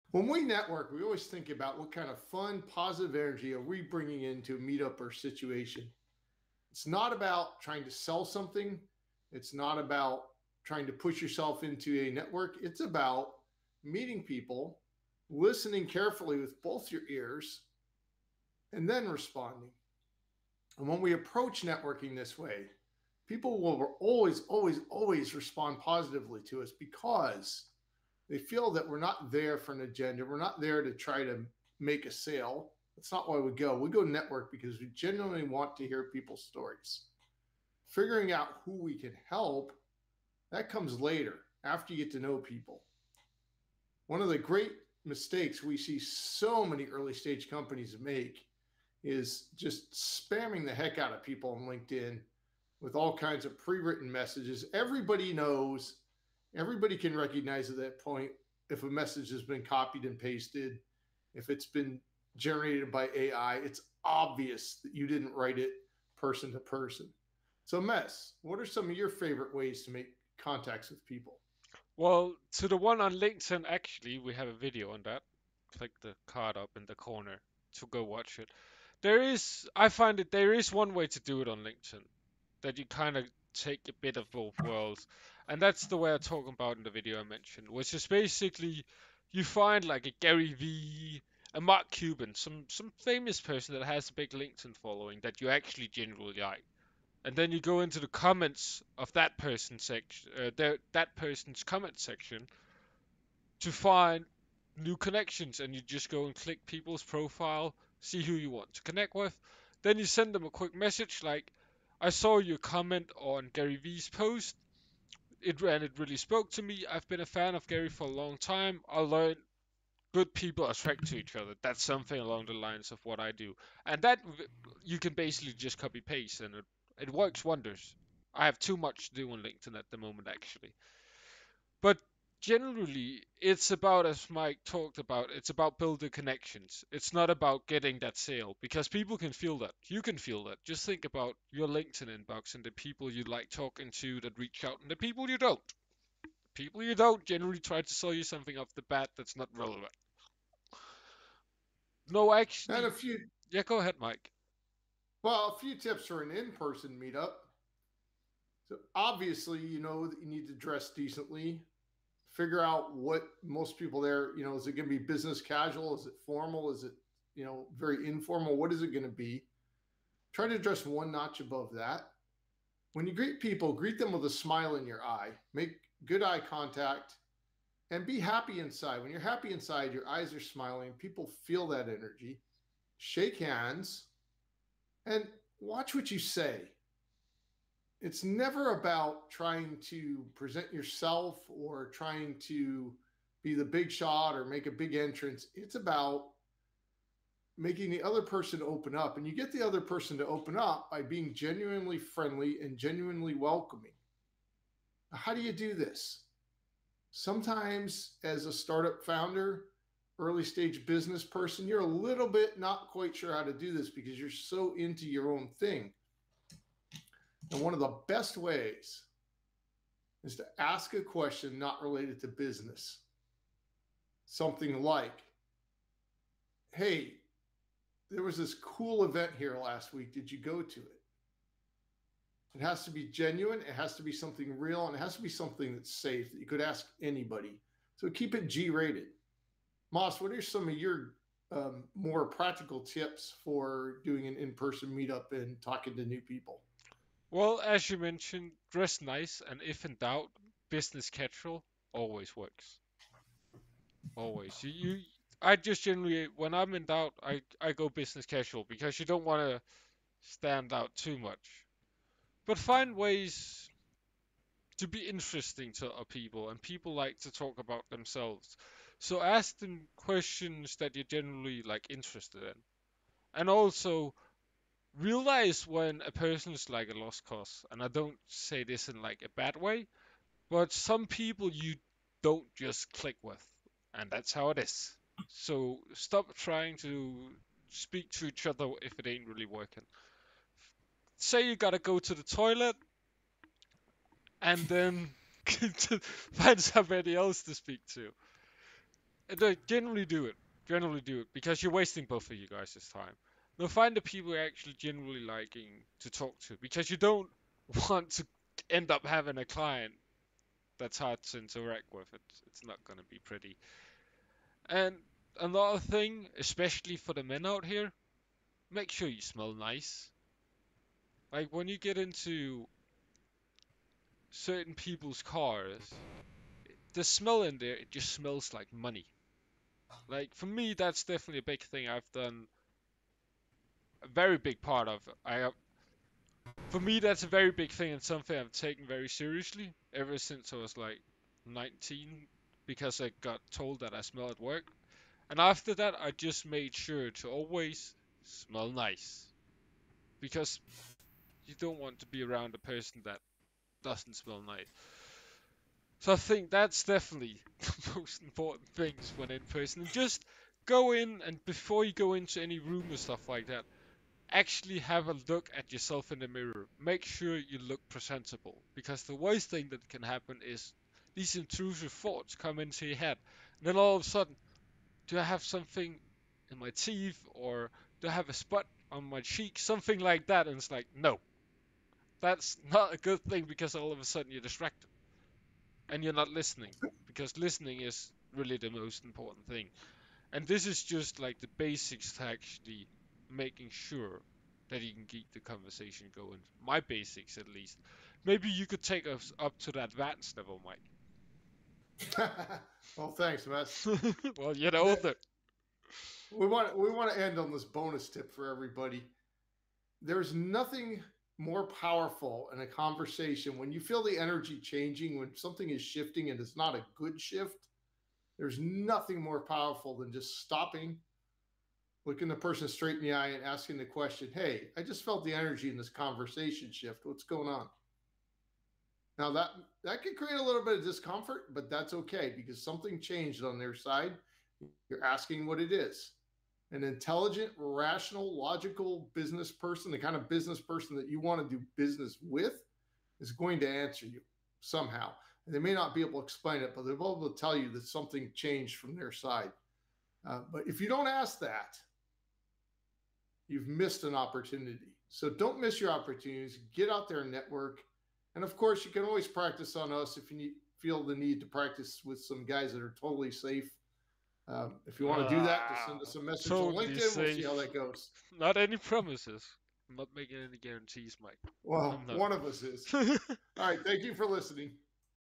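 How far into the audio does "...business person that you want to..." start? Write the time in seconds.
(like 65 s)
440 s.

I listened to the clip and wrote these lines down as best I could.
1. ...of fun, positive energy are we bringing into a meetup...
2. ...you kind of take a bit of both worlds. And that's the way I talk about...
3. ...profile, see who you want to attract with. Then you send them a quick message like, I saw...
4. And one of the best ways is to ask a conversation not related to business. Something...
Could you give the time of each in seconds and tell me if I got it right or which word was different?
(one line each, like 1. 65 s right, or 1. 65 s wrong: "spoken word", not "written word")
1. 2 s right
2. 82 s right
3. 107 s wrong: "connect", not "attract"
4. 217 s wrong: "question", not "conversation".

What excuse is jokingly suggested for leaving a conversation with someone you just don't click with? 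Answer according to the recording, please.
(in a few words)
go to the toilet.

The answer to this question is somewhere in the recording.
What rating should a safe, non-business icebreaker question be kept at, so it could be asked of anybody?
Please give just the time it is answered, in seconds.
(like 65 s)
238 s.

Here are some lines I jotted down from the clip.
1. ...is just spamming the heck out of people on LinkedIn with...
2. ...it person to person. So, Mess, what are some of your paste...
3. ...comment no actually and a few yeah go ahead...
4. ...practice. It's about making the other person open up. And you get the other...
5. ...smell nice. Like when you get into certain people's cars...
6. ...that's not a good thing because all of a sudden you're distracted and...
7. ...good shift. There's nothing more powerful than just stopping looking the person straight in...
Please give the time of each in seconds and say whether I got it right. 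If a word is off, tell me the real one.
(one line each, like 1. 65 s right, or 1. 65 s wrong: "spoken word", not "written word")
1. 49 s right
2. 65 s wrong: "favorite", not "paste"
3. 149 s wrong: "relevant", not "comment"
4. 194 s wrong: "entrance", not "practice"
5. 319 s right
6. 382 s right
7. 416 s right.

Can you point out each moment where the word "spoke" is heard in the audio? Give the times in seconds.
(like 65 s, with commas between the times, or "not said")
116 s.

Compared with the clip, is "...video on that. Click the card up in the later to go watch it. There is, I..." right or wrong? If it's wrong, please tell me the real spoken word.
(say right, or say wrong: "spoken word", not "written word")
wrong: "corner", not "later".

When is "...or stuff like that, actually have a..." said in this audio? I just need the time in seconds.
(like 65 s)
362 s.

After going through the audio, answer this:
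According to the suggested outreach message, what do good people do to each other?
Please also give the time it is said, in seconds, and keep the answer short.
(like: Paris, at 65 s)
attract, at 120 s.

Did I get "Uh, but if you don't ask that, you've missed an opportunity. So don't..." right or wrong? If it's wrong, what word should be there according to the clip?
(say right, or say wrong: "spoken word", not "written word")
right.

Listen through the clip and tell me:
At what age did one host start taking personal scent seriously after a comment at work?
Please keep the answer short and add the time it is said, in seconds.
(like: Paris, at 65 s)
19, at 341 s.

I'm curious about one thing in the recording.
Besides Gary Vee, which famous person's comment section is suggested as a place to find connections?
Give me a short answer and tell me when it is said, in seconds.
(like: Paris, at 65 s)
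Mark Cuban, at 91 s.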